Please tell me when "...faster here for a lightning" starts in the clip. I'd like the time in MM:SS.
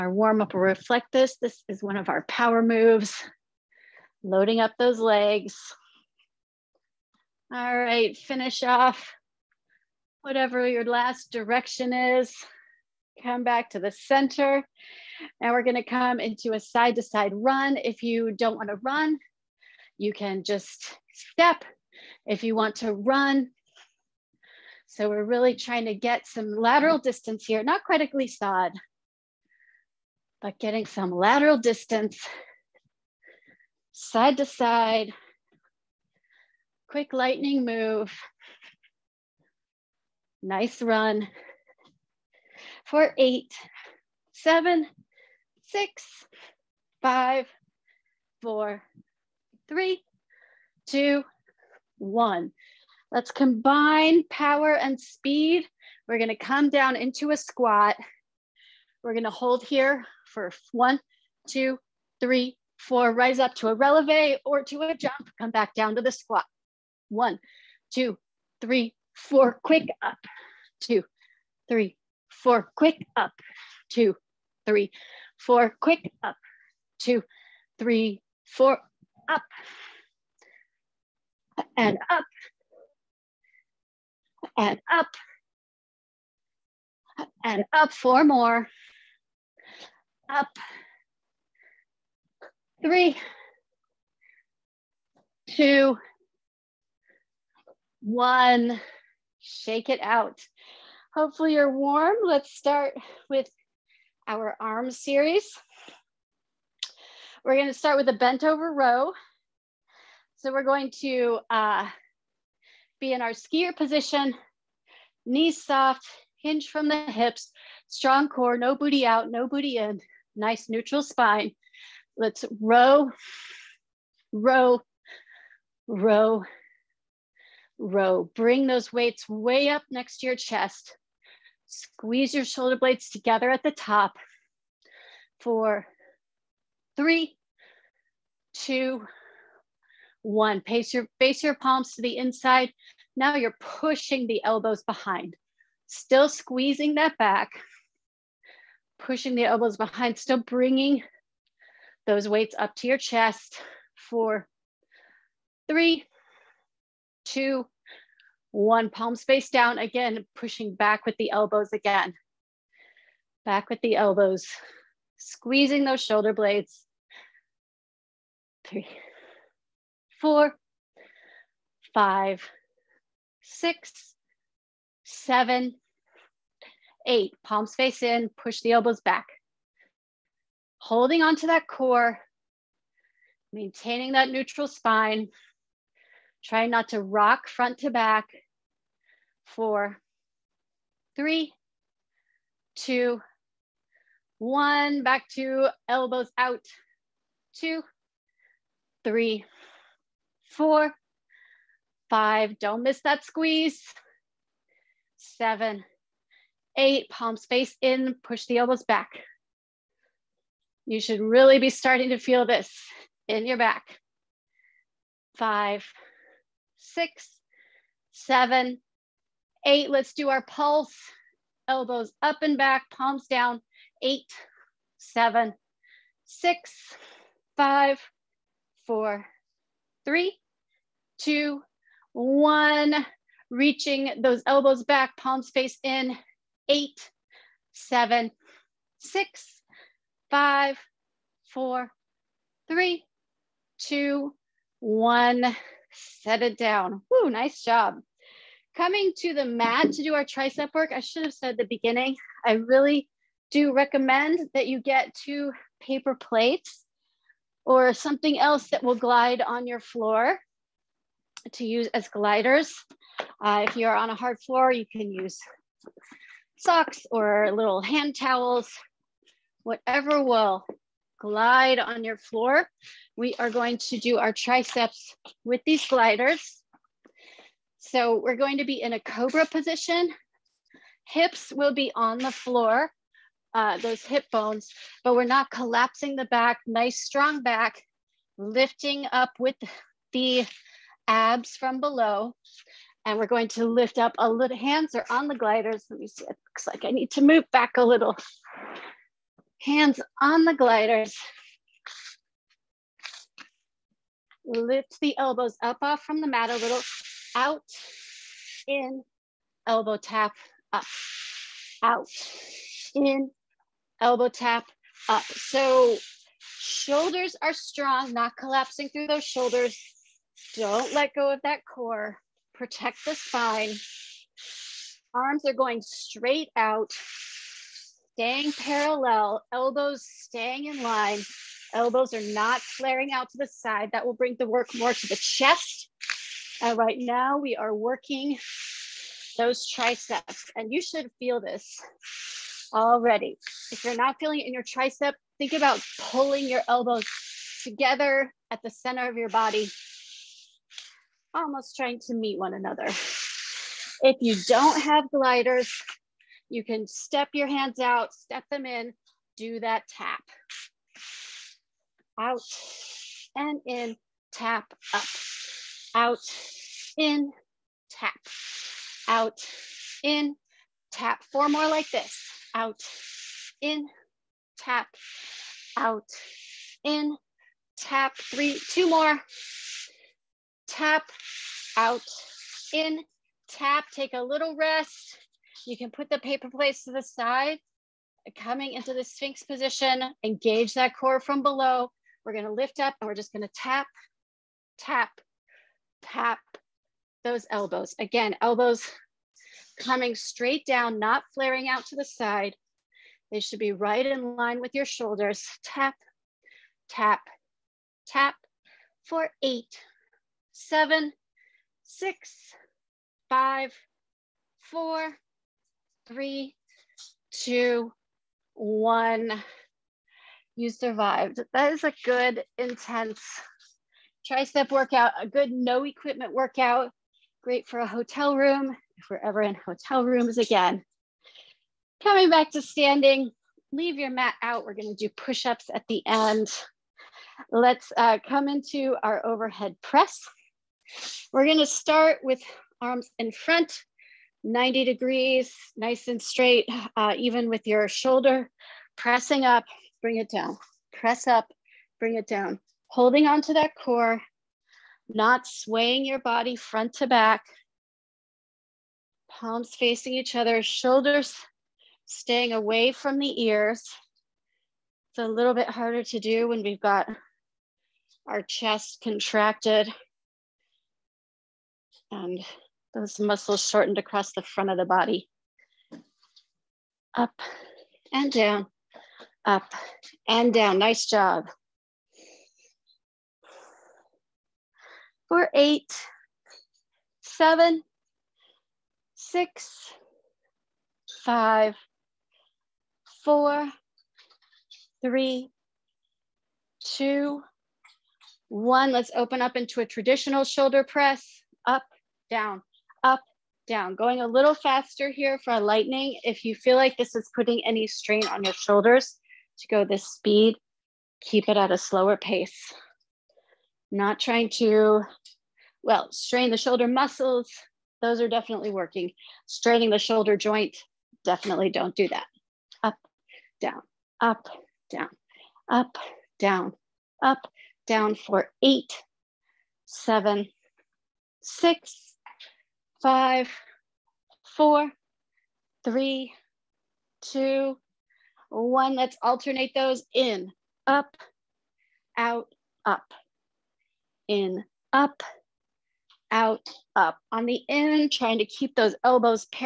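08:24.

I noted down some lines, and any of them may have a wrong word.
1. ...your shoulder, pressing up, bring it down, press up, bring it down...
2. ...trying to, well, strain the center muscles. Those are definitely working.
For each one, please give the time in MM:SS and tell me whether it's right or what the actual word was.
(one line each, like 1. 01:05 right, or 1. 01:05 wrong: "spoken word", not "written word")
1. 07:27 right
2. 08:34 wrong: "shoulder", not "center".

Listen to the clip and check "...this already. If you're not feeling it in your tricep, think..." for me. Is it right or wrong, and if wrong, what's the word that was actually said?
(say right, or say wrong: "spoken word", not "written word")
right.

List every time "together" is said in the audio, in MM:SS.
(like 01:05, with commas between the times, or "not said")
02:13, 05:47.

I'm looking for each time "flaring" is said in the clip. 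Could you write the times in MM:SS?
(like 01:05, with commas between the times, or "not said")
05:32, 06:41.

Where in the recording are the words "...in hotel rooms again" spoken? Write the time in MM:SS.
07:09.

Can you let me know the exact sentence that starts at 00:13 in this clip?
Come back to the center now we're gonna come into a side to side run.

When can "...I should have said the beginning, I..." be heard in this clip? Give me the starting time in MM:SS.
04:10.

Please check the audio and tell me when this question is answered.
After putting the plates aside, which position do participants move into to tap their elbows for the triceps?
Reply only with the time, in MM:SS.
06:29.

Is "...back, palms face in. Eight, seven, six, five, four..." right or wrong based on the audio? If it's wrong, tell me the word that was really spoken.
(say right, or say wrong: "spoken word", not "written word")
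right.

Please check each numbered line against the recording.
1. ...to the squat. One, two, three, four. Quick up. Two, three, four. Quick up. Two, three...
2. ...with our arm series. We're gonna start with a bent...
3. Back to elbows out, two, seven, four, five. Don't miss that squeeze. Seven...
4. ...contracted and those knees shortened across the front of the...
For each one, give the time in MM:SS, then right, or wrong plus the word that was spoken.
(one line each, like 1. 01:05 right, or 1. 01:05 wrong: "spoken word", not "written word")
1. 01:05 right
2. 01:43 right
3. 03:15 wrong: "three", not "seven"
4. 07:49 wrong: "muscles", not "knees".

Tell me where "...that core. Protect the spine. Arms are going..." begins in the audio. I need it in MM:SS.
05:21.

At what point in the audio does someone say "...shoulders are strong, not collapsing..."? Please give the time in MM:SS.
05:16.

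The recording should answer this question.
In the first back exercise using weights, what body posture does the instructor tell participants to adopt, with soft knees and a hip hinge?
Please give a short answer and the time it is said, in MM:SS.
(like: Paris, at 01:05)
skier position, at 01:53.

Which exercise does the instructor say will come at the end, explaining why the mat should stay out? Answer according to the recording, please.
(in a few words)
push-ups.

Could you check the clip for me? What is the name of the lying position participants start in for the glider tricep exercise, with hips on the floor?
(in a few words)
cobra position.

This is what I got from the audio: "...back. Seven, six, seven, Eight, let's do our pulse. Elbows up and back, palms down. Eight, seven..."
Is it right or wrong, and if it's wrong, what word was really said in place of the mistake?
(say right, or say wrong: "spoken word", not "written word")
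wrong: "Five", not "Seven".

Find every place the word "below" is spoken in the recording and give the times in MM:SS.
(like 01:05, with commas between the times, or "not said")
04:51, 06:31.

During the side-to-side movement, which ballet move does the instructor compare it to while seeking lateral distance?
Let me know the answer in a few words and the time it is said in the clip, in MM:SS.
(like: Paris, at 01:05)
glissade, at 00:28.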